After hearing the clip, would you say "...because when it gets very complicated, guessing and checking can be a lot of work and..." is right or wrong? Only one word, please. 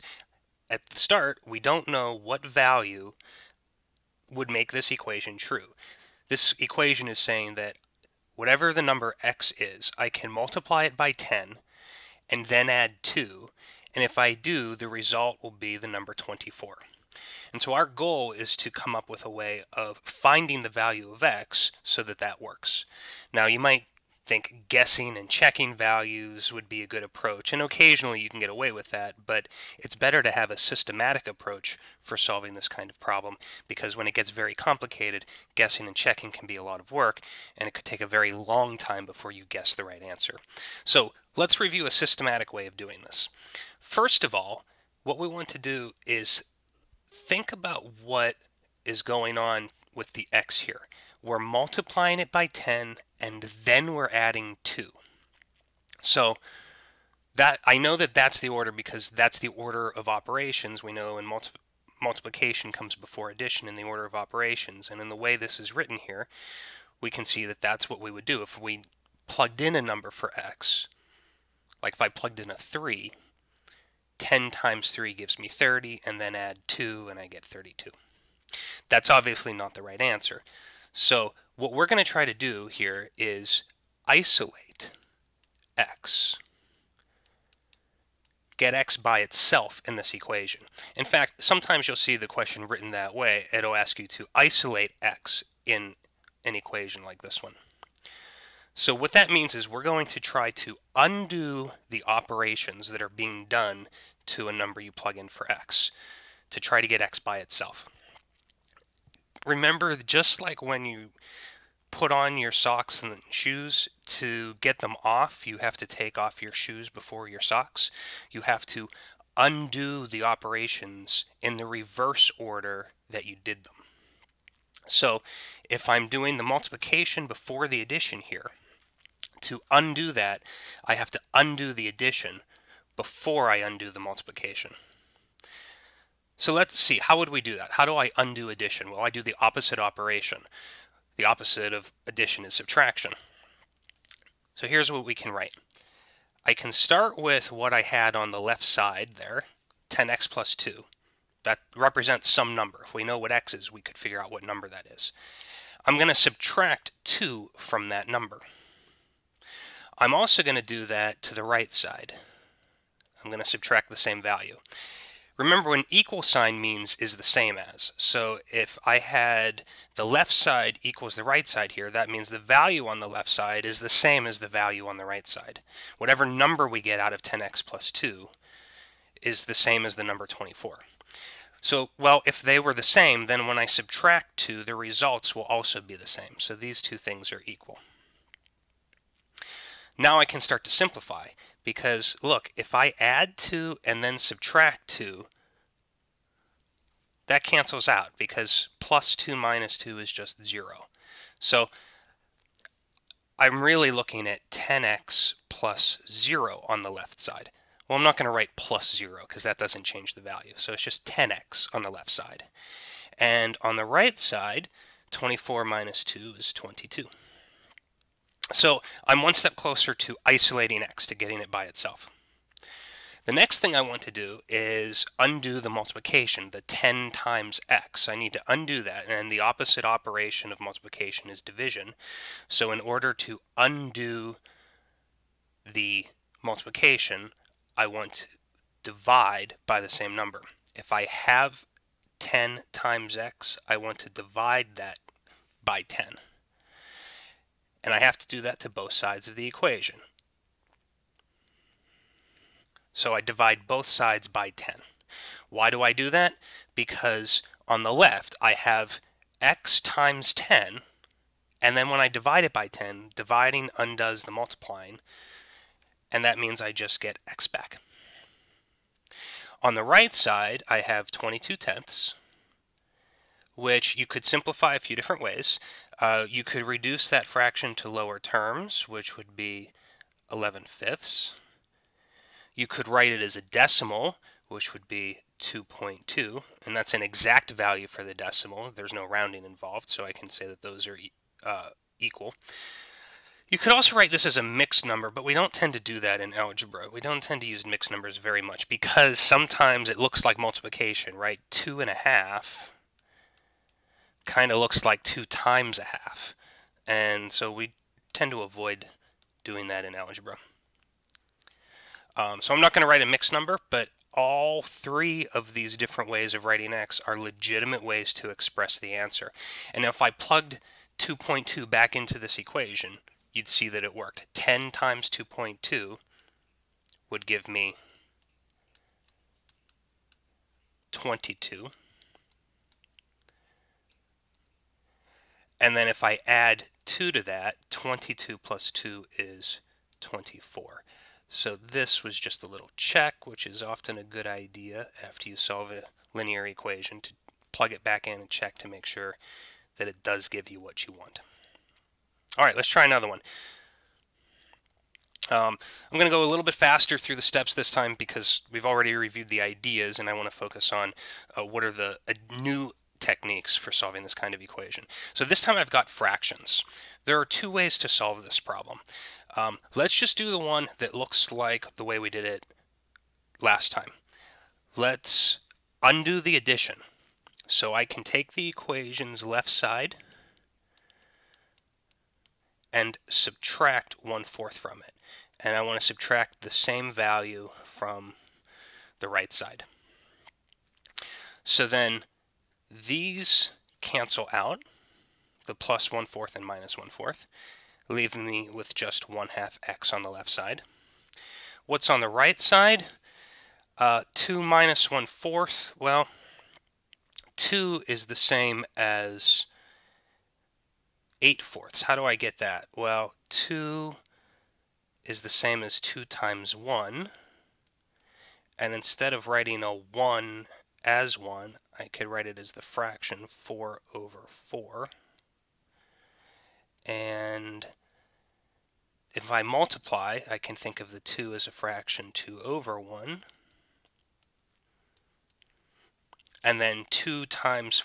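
right.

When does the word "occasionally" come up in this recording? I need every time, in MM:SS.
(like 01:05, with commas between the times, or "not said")
00:27.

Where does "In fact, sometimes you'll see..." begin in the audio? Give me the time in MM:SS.
01:30.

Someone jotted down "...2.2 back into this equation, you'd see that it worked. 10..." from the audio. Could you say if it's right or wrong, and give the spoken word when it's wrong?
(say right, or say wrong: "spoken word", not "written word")
right.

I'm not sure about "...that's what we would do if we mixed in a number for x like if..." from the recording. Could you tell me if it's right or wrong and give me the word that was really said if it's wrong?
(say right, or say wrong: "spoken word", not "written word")
wrong: "plugged", not "mixed".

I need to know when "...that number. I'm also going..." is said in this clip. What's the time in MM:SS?
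02:37.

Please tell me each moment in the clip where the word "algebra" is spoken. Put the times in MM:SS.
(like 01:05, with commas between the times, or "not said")
04:56, 05:09.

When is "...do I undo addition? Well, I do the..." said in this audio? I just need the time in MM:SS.
02:17.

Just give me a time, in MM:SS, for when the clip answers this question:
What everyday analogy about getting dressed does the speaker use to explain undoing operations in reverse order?
01:52.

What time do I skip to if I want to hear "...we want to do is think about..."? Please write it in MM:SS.
00:45.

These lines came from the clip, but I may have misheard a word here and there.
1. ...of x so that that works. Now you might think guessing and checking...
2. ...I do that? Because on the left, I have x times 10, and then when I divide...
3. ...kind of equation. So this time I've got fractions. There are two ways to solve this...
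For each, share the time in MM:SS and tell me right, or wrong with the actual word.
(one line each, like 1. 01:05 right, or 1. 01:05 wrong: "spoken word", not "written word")
1. 00:21 right
2. 04:15 right
3. 06:04 right.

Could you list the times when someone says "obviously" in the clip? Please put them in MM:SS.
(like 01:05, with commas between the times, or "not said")
01:19.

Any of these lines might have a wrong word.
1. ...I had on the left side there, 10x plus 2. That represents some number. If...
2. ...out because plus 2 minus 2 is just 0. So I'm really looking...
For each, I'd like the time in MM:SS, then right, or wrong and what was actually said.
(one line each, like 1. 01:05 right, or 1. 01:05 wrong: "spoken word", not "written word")
1. 02:27 right
2. 03:17 right.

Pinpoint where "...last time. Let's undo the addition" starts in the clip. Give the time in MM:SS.
06:13.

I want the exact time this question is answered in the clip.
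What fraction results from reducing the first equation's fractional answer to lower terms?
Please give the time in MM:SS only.
04:40.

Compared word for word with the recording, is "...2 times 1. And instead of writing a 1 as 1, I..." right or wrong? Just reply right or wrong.
right.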